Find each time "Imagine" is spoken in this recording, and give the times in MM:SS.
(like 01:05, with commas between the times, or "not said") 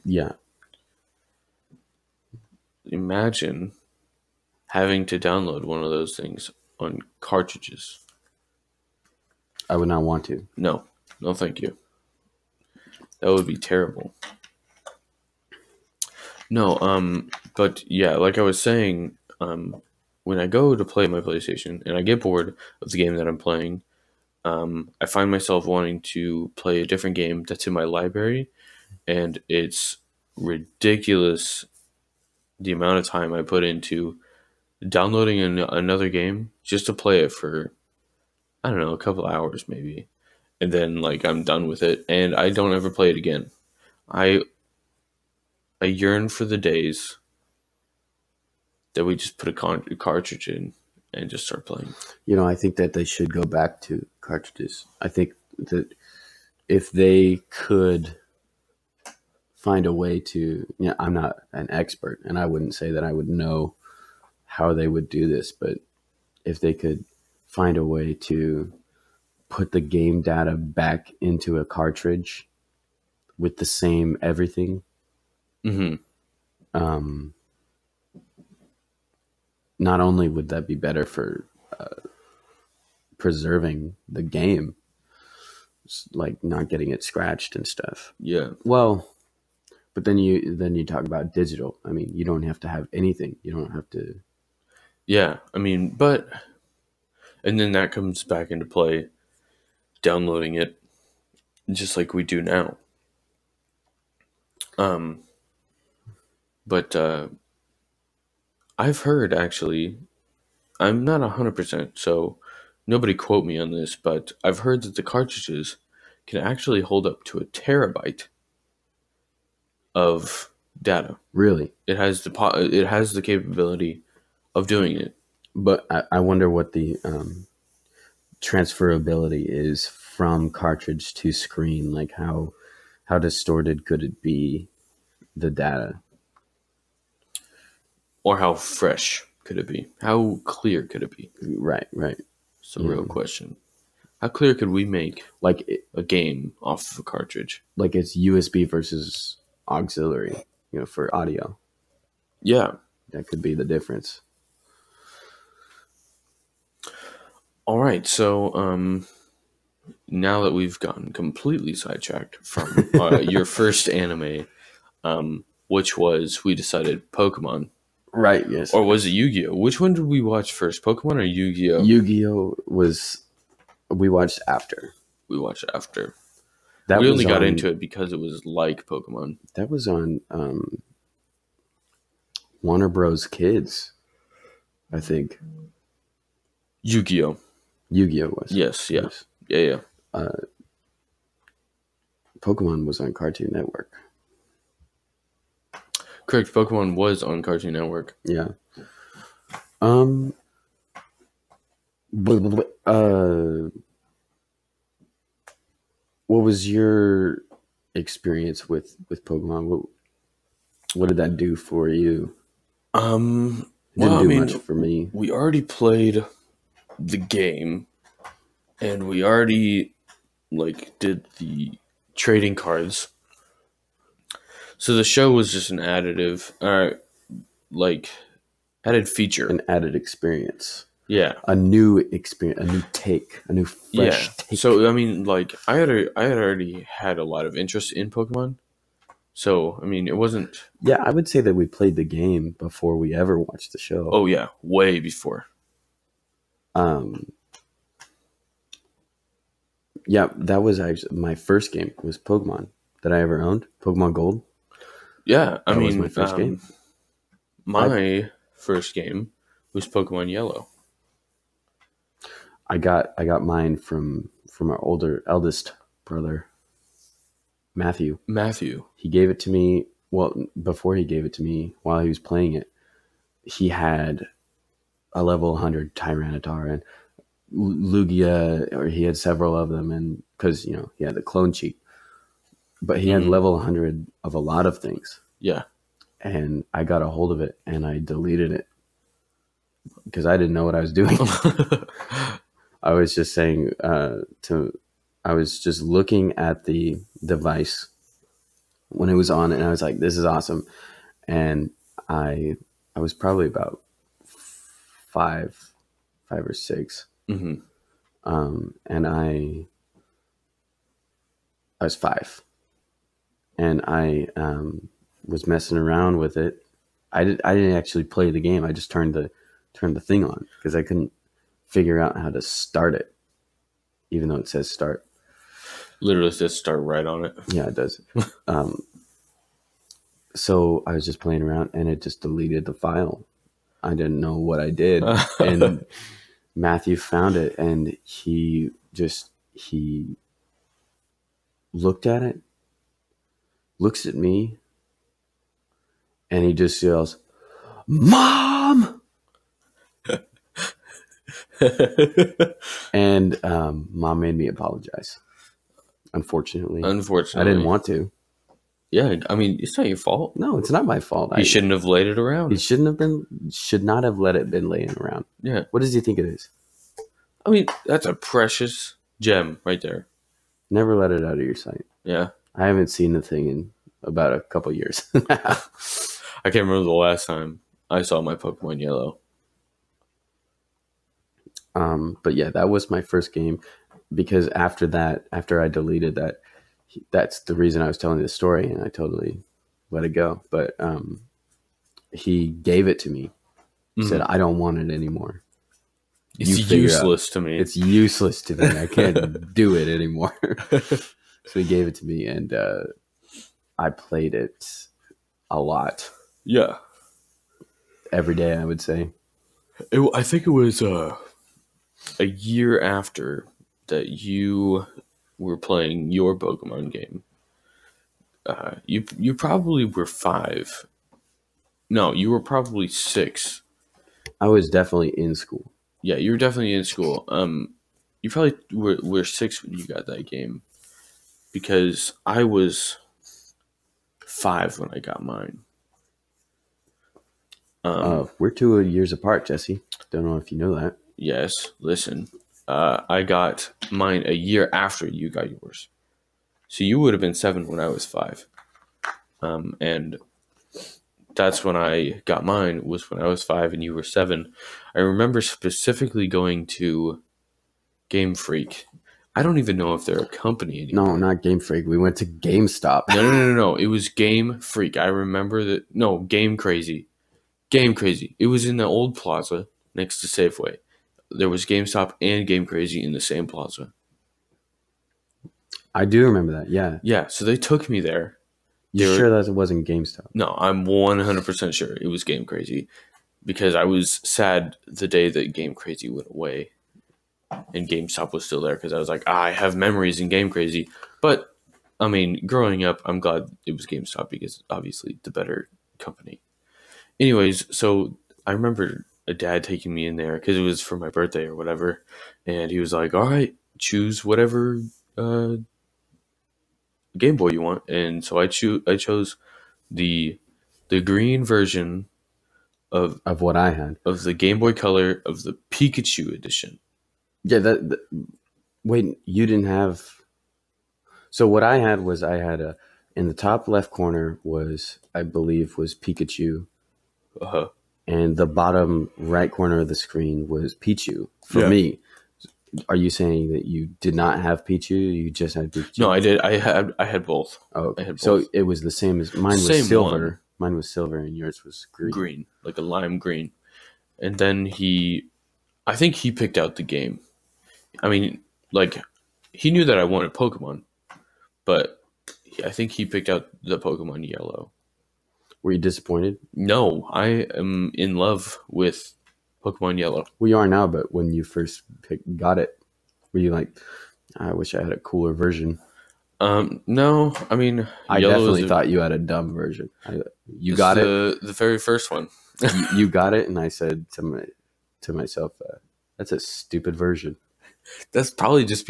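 00:02.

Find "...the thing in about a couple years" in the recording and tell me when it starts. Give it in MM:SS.
06:13.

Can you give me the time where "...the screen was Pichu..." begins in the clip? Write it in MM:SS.
08:49.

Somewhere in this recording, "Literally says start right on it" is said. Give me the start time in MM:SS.
05:26.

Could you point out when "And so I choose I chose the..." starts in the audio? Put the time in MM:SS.
08:27.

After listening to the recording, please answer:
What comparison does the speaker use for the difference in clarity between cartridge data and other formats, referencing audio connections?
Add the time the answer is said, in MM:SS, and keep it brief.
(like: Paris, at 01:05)
USB versus auxiliary, at 02:28.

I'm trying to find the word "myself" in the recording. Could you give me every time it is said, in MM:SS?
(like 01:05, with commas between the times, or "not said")
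00:25, 09:35.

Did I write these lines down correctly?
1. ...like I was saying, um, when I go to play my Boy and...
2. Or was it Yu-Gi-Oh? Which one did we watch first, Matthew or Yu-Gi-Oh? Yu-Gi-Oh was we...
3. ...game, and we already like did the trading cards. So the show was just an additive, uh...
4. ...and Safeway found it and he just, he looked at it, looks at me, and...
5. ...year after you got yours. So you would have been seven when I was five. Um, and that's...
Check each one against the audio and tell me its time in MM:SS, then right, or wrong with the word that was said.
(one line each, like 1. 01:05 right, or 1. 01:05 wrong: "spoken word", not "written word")
1. 00:18 wrong: "PlayStation", not "Boy"
2. 02:48 wrong: "Pokemon", not "Matthew"
3. 03:37 right
4. 05:35 wrong: "Matthew", not "Safeway"
5. 07:24 right.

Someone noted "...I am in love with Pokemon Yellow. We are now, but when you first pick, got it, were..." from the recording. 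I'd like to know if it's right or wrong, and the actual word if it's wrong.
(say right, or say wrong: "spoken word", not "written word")
right.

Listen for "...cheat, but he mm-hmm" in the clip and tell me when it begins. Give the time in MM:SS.
04:41.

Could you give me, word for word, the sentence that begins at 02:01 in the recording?
Really, it has the po- it has the capability of doing it.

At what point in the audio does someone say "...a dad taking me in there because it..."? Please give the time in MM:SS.
08:19.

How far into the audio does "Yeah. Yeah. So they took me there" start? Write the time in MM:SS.
07:56.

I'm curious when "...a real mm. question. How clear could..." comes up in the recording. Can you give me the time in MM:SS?
02:22.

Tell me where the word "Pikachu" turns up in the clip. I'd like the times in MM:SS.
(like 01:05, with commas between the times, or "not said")
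08:35, 08:45.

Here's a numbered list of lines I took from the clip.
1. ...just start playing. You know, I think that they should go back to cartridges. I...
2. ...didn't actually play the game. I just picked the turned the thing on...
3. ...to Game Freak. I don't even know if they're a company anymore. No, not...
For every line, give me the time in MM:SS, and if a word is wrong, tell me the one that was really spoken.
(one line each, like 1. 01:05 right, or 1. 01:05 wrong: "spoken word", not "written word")
1. 00:51 right
2. 05:17 wrong: "turned", not "picked"
3. 07:36 right.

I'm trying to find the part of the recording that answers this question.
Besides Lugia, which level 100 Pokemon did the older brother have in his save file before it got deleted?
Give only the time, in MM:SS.
04:35.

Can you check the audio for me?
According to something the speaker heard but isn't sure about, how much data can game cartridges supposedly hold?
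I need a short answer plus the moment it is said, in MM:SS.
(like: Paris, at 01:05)
a terabyte, at 01:57.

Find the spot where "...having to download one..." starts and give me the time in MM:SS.
00:04.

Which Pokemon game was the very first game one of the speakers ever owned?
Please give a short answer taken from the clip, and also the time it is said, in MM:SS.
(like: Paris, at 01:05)
Pokemon Gold, at 04:13.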